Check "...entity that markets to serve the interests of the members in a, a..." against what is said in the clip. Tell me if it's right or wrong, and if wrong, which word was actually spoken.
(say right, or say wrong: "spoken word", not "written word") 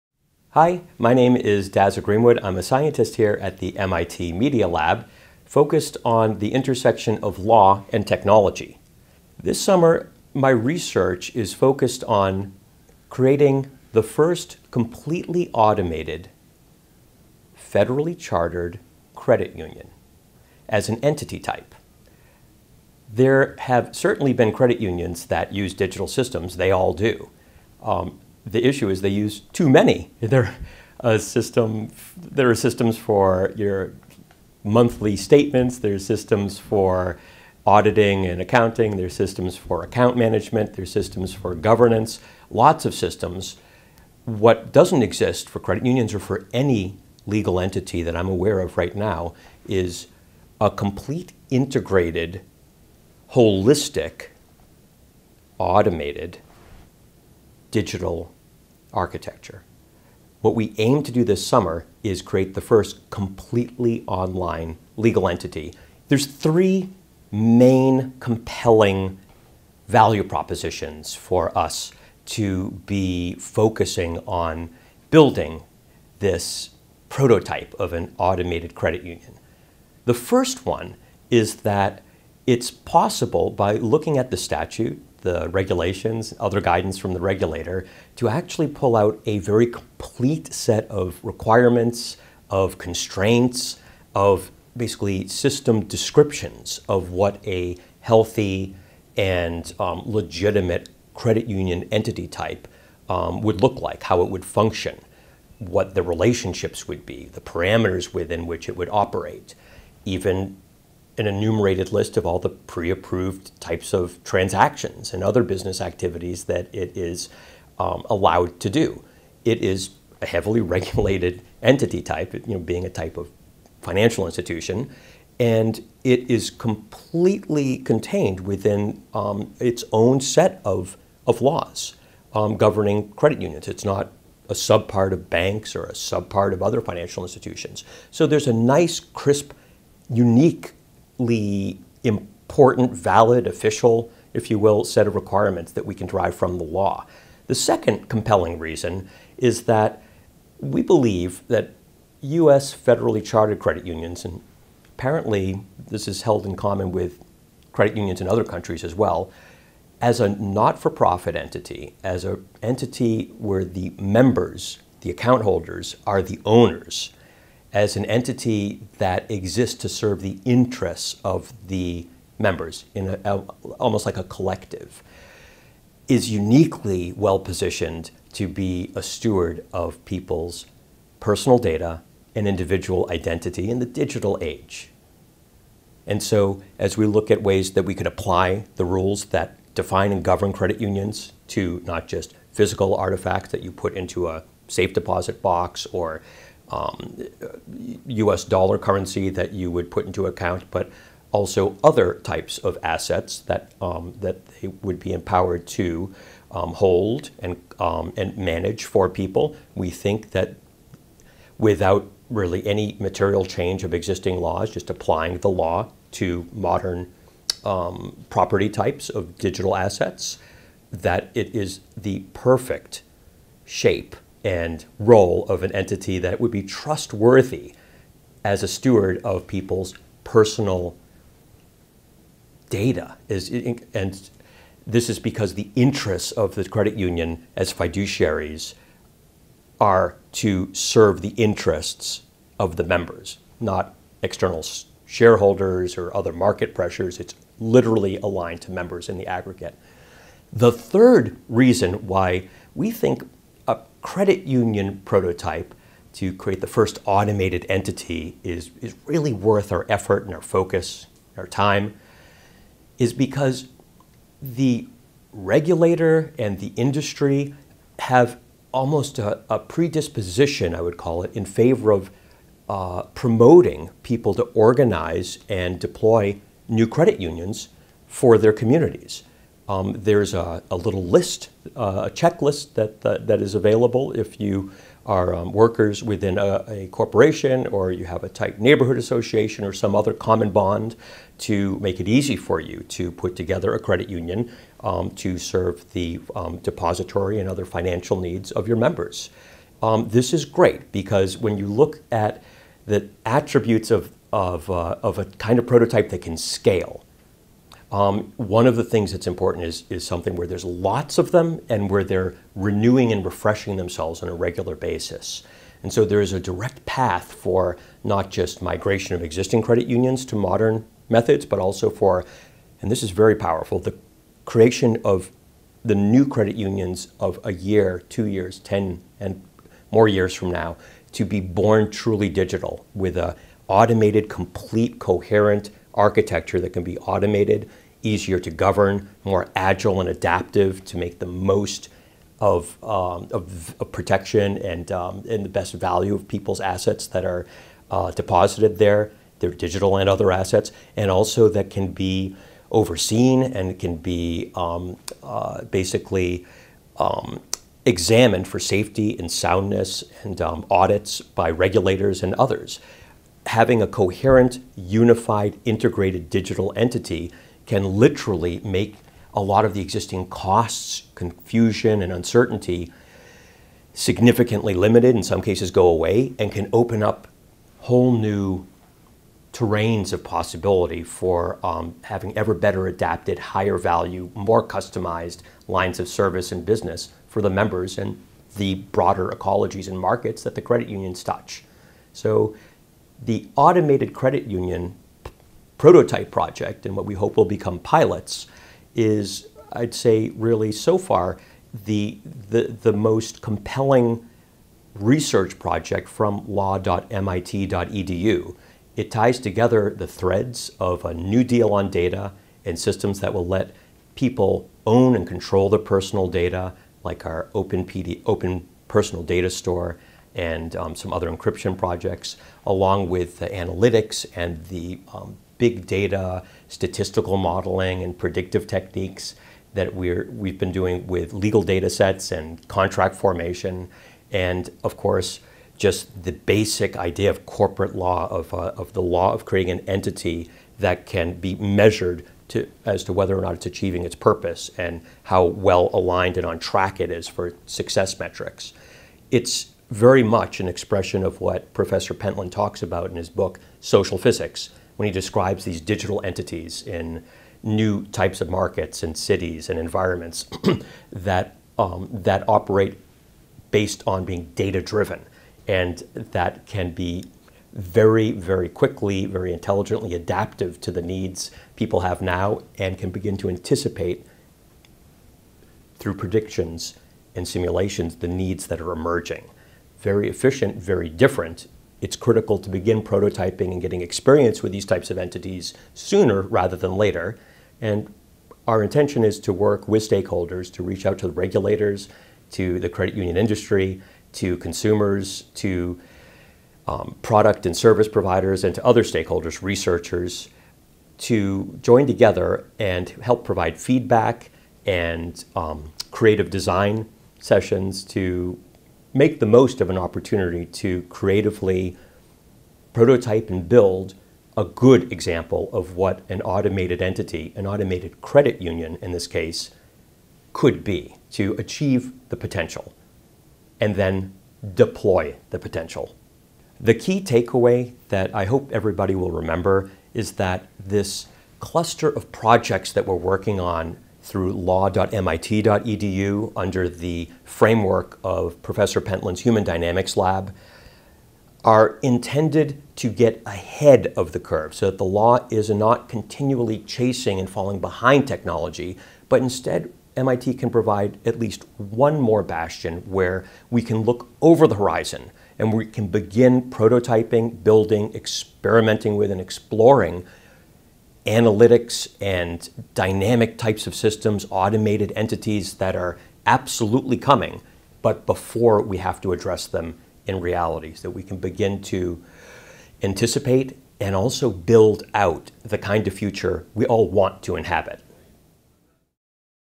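wrong: "exists", not "markets".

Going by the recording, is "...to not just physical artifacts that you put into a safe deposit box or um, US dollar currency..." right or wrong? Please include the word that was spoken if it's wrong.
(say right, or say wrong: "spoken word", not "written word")
right.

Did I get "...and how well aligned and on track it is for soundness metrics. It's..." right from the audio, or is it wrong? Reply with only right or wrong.
wrong.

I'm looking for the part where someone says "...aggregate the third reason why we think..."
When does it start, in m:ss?
4:09.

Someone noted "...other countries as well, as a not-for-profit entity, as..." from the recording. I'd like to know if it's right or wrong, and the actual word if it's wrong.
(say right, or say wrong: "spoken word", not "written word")
right.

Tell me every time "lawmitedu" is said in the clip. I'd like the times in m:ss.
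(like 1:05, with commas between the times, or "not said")
6:46, 8:54.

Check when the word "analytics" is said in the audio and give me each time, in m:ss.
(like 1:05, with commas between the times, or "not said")
7:03, 9:21.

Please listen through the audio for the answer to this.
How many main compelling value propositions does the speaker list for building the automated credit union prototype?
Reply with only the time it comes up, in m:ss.
1:06.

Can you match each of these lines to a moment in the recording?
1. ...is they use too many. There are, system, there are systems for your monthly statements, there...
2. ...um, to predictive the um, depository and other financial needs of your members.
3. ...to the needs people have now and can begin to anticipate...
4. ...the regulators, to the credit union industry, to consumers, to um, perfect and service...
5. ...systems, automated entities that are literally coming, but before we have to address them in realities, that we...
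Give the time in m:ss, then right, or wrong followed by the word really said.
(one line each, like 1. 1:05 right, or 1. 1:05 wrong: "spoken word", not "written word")
1. 0:28 right
2. 4:54 wrong: "serve", not "predictive"
3. 7:50 right
4. 8:11 wrong: "product", not "perfect"
5. 9:23 wrong: "absolutely", not "literally".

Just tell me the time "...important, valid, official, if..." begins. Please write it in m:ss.
2:22.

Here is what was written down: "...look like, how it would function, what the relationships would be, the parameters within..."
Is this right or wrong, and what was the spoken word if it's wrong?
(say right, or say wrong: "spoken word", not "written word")
right.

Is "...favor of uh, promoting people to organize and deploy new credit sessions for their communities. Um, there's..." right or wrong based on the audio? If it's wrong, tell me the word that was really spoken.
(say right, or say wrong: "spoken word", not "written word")
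wrong: "unions", not "sessions".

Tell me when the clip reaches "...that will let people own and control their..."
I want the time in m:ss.
6:53.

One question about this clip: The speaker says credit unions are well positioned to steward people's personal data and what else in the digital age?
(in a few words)
individual identity.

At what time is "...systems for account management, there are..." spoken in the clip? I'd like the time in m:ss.
0:39.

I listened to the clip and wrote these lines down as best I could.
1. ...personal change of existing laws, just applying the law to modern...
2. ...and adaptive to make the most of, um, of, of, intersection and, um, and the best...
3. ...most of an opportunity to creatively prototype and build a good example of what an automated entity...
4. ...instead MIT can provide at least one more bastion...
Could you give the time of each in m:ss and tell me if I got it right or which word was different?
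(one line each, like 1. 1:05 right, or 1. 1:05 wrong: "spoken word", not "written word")
1. 3:32 wrong: "material", not "personal"
2. 5:39 wrong: "protection", not "intersection"
3. 8:29 right
4. 9:09 right.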